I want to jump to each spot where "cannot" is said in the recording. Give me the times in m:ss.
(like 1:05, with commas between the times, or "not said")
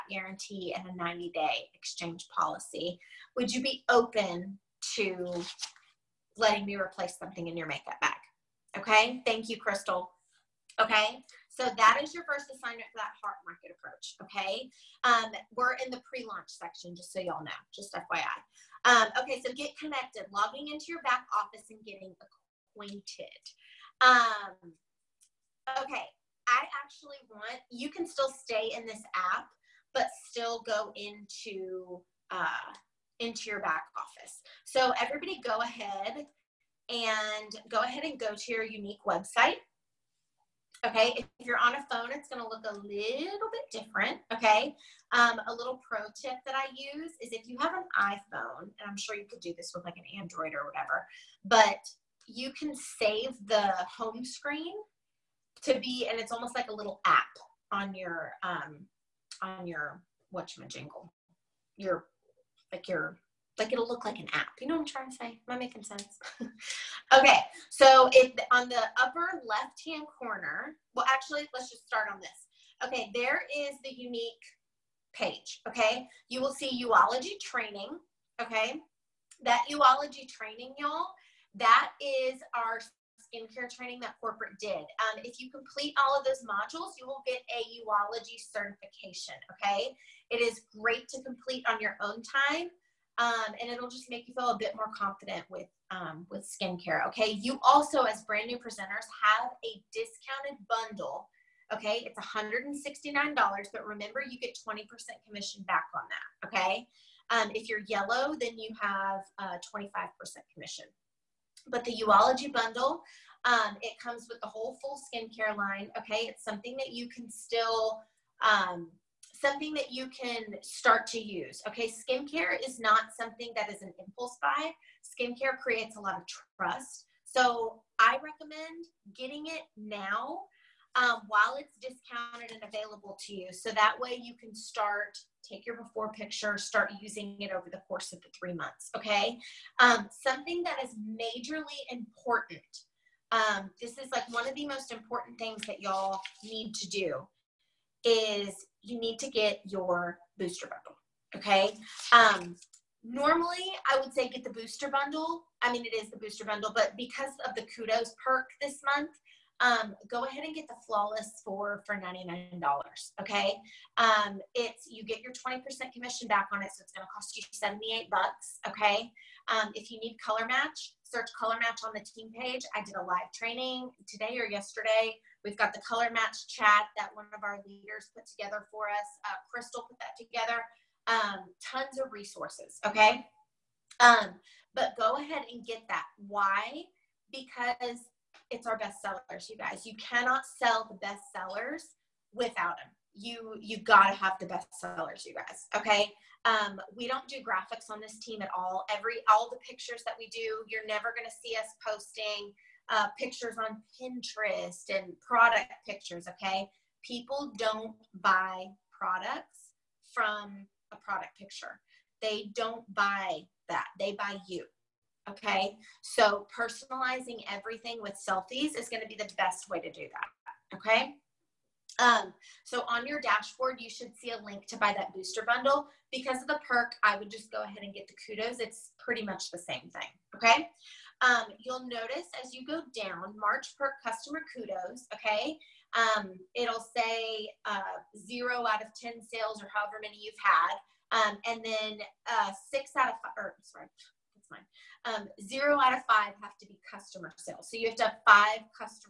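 3:09.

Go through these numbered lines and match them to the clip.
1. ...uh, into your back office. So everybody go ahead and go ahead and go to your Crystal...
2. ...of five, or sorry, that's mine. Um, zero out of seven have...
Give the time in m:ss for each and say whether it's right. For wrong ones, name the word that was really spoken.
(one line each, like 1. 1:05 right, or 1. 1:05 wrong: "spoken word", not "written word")
1. 0:32 wrong: "Younique", not "Crystal"
2. 4:03 wrong: "five", not "seven".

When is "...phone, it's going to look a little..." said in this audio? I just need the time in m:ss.
0:41.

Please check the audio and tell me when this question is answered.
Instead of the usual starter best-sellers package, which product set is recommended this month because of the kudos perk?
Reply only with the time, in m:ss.
2:40.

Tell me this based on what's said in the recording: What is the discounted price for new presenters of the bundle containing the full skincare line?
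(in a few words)
$169.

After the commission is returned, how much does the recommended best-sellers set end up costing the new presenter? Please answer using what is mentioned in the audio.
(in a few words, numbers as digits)
$78.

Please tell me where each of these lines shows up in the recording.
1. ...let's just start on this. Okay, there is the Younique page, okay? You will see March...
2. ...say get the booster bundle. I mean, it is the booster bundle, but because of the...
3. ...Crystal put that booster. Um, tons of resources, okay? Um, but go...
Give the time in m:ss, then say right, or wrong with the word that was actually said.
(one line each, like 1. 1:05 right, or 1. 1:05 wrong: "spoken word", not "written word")
1. 1:11 wrong: "Uology", not "March"
2. 2:34 right
3. 2:59 wrong: "together", not "booster".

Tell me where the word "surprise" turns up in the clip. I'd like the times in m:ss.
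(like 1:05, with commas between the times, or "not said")
not said.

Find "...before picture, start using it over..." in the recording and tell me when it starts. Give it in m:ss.
2:15.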